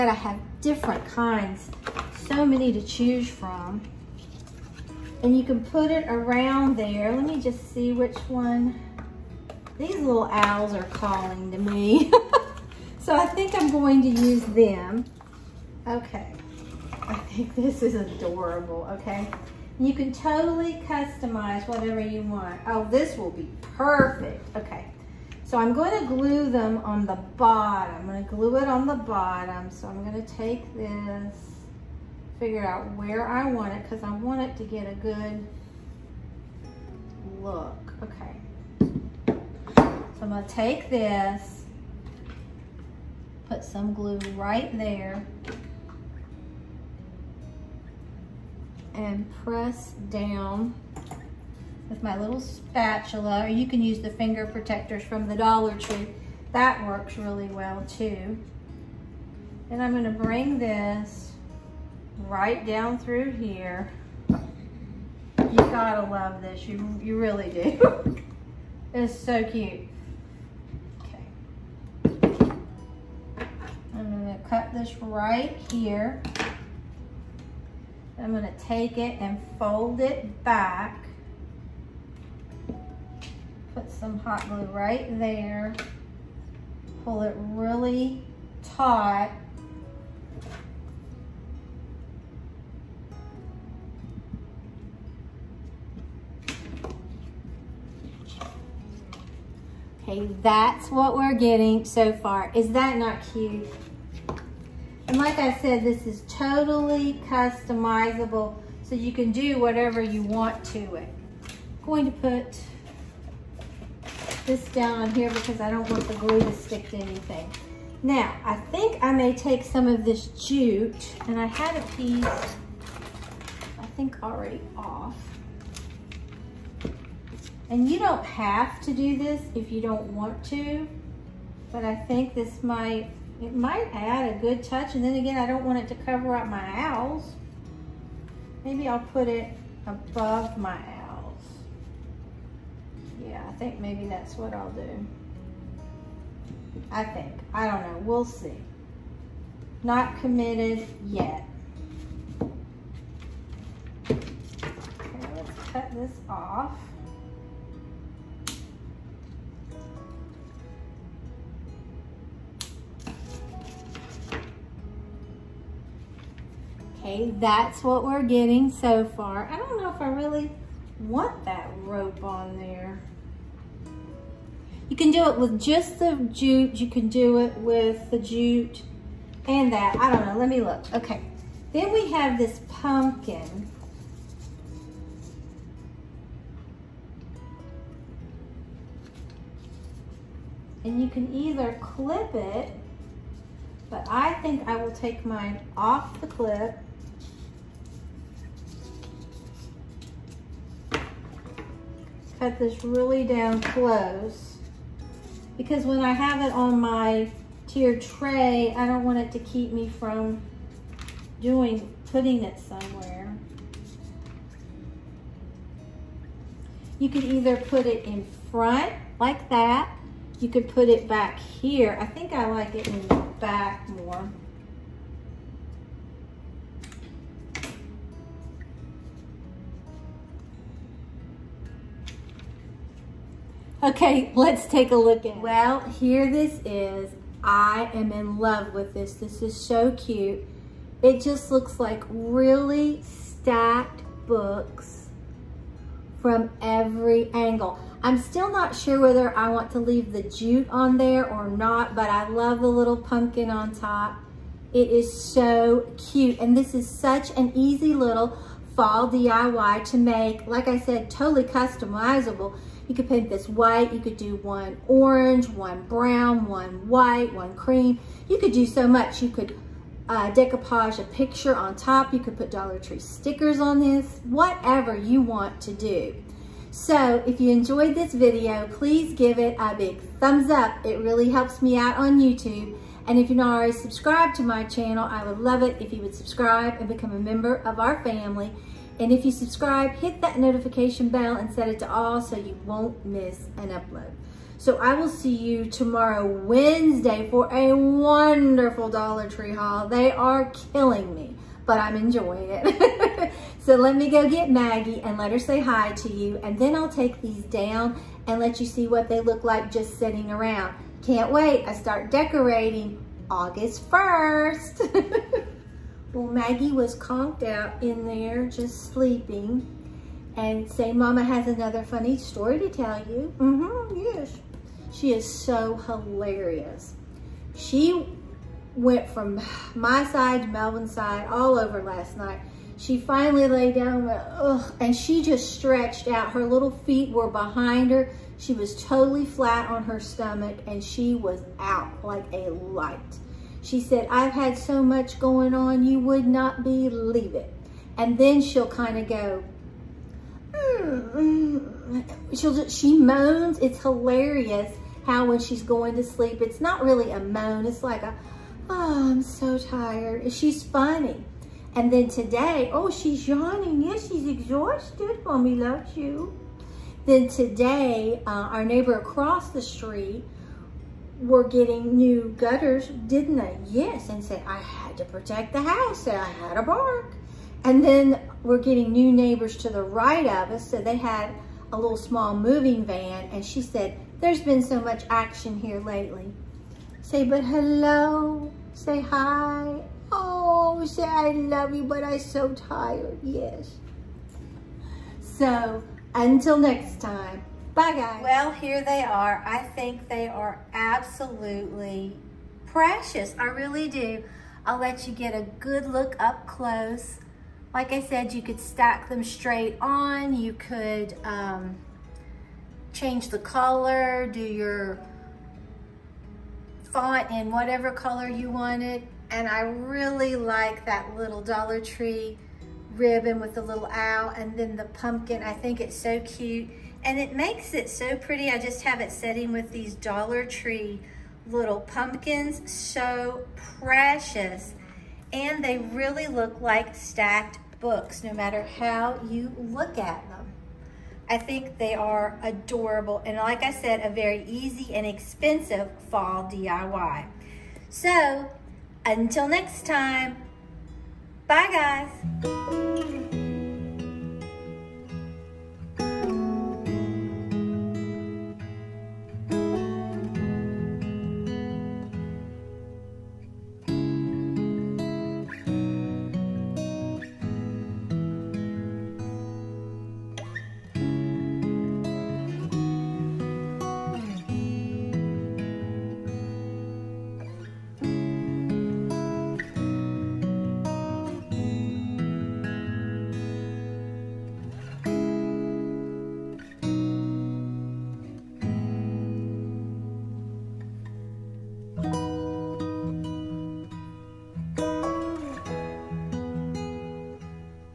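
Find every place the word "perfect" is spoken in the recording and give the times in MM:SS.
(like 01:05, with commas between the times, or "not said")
00:23.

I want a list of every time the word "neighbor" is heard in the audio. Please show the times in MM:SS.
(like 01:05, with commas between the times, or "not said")
06:08, 06:19.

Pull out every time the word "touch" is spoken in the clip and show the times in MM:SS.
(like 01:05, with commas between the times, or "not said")
02:14.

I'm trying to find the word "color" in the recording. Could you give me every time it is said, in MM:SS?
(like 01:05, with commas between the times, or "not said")
06:53, 06:57.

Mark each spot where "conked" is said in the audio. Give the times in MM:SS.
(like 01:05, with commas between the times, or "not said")
05:16.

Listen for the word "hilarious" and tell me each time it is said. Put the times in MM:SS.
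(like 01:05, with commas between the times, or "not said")
05:25, 05:53.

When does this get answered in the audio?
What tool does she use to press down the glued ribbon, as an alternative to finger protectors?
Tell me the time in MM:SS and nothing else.
00:52.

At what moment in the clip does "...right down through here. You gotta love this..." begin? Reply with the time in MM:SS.
01:02.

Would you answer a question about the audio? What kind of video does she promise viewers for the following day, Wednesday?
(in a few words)
Dollar Tree haul.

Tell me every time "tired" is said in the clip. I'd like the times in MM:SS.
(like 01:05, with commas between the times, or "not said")
05:59, 06:32.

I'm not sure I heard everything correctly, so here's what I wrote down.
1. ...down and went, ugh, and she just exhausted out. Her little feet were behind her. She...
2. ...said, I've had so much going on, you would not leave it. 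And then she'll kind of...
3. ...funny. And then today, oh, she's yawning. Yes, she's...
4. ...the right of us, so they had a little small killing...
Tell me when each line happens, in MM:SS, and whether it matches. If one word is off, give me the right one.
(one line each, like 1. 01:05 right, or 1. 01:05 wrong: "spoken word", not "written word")
1. 05:33 wrong: "stretched", not "exhausted"
2. 05:43 wrong: "believe", not "leave"
3. 06:00 right
4. 06:19 wrong: "moving", not "killing".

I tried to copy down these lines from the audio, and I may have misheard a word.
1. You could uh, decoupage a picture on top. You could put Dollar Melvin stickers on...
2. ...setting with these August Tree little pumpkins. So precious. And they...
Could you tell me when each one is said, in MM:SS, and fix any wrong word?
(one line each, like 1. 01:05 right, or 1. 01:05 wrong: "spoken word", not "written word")
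1. 04:29 wrong: "Tree", not "Melvin"
2. 07:09 wrong: "Dollar", not "August".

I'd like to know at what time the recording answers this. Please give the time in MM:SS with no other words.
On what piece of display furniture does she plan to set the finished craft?
03:27.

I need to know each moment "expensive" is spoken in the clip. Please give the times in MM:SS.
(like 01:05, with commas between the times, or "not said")
07:25.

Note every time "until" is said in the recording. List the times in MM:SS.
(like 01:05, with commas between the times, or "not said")
06:36, 07:29.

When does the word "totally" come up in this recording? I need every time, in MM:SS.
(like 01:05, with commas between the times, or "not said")
00:20, 01:46, 04:21, 05:38.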